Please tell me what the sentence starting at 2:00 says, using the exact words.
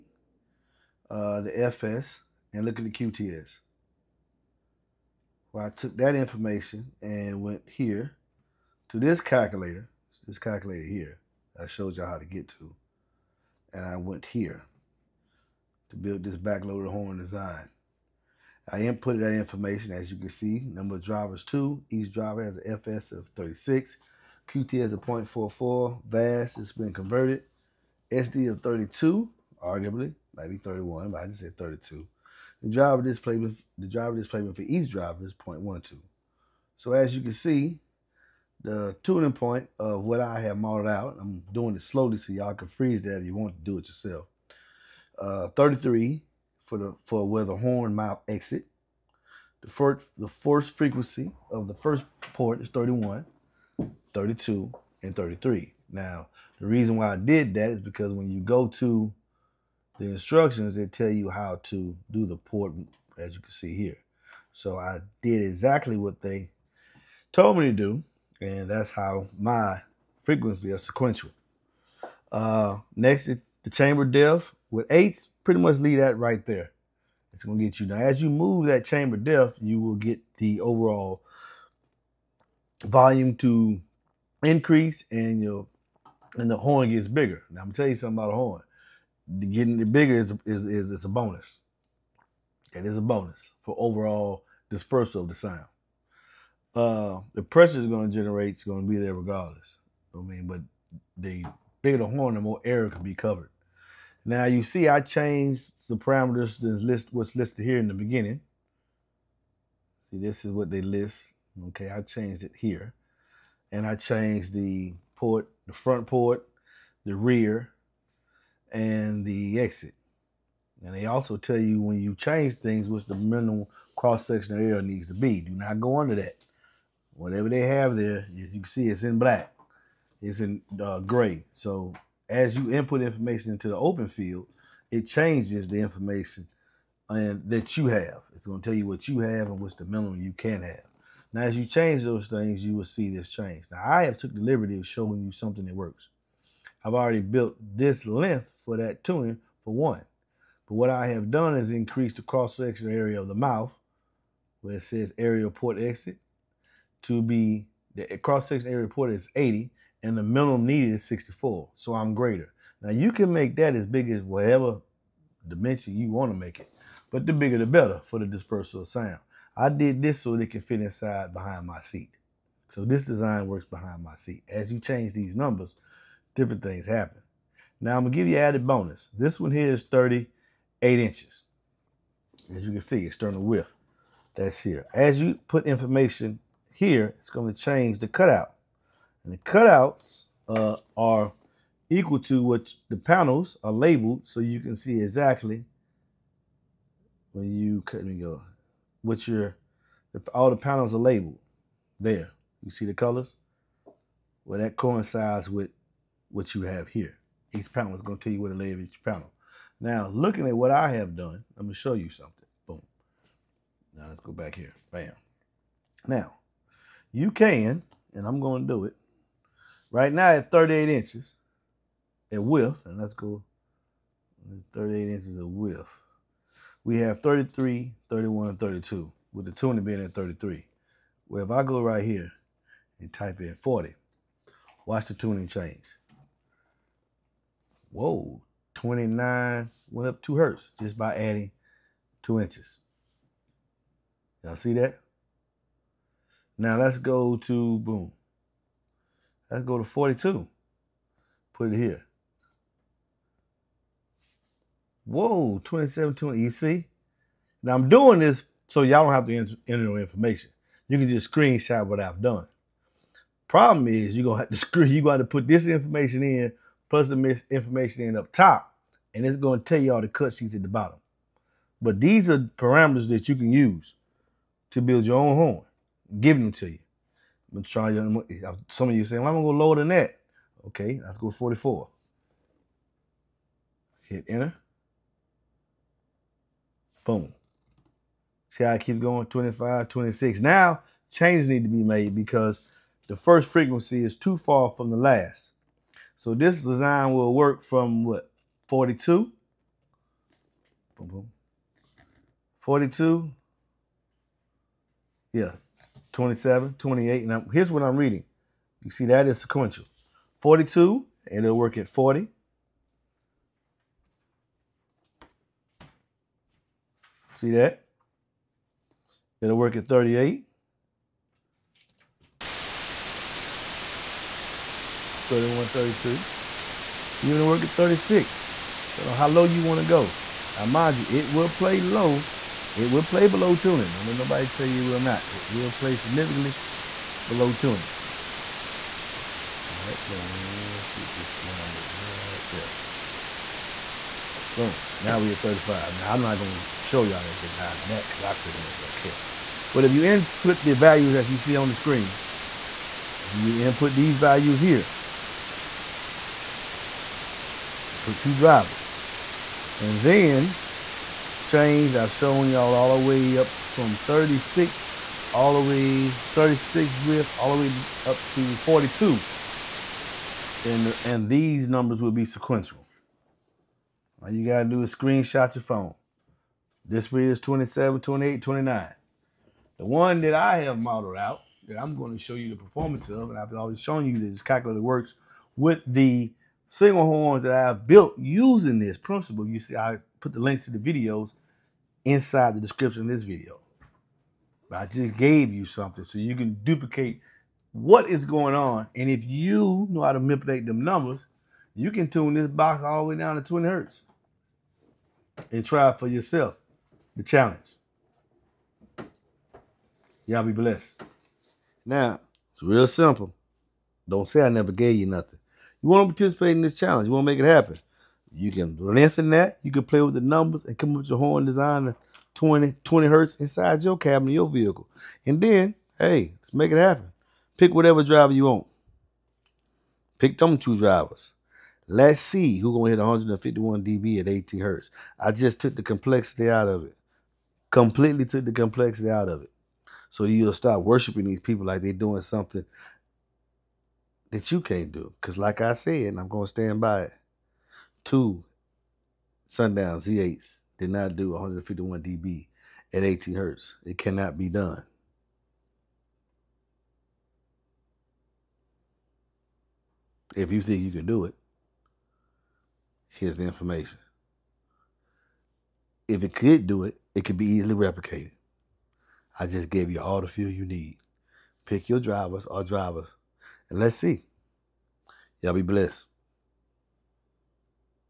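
And they also tell you when you change things, which the minimum cross sectional area needs to be.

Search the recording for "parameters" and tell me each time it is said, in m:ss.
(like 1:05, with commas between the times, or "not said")
1:45, 4:32.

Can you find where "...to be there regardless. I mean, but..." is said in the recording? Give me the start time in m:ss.
1:38.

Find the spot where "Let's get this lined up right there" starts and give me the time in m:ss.
5:40.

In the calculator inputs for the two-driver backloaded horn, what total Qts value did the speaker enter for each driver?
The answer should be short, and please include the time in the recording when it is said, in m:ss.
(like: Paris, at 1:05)
0.44, at 0:24.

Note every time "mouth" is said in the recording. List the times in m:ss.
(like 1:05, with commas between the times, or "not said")
0:47, 2:33.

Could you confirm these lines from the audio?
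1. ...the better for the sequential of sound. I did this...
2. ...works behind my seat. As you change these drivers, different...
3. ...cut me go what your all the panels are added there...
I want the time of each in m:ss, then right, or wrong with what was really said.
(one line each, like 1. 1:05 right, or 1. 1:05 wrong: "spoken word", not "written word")
1. 2:47 wrong: "dispersal", not "sequential"
2. 2:53 wrong: "numbers", not "drivers"
3. 3:17 wrong: "labeled", not "added".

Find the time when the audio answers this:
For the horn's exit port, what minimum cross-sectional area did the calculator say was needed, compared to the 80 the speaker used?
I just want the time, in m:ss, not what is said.
2:41.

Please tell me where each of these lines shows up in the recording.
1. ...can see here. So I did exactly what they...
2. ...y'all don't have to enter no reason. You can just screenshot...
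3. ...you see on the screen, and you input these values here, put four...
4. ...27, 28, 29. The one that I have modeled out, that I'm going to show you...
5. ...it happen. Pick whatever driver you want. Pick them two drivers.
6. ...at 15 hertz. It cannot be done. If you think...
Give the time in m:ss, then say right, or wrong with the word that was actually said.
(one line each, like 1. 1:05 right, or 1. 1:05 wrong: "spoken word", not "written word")
1. 1:03 right
2. 4:18 wrong: "information", not "reason"
3. 5:51 wrong: "two", not "four"
4. 6:17 right
5. 7:06 right
6. 7:32 wrong: "18", not "15".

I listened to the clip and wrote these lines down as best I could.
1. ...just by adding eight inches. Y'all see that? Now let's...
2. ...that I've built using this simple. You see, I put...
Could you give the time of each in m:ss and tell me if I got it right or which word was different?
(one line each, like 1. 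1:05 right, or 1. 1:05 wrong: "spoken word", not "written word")
1. 4:00 wrong: "two", not "eight"
2. 6:27 wrong: "principle", not "simple".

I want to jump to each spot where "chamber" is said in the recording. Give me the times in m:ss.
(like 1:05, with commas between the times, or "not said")
1:13, 1:18.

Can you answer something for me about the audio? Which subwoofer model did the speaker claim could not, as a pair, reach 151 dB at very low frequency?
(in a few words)
Sundown Z8.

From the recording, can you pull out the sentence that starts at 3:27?
Each panel is going to tell you where to lay each panel.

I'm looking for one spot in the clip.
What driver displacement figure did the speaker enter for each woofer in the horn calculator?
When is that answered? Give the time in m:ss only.
0:35.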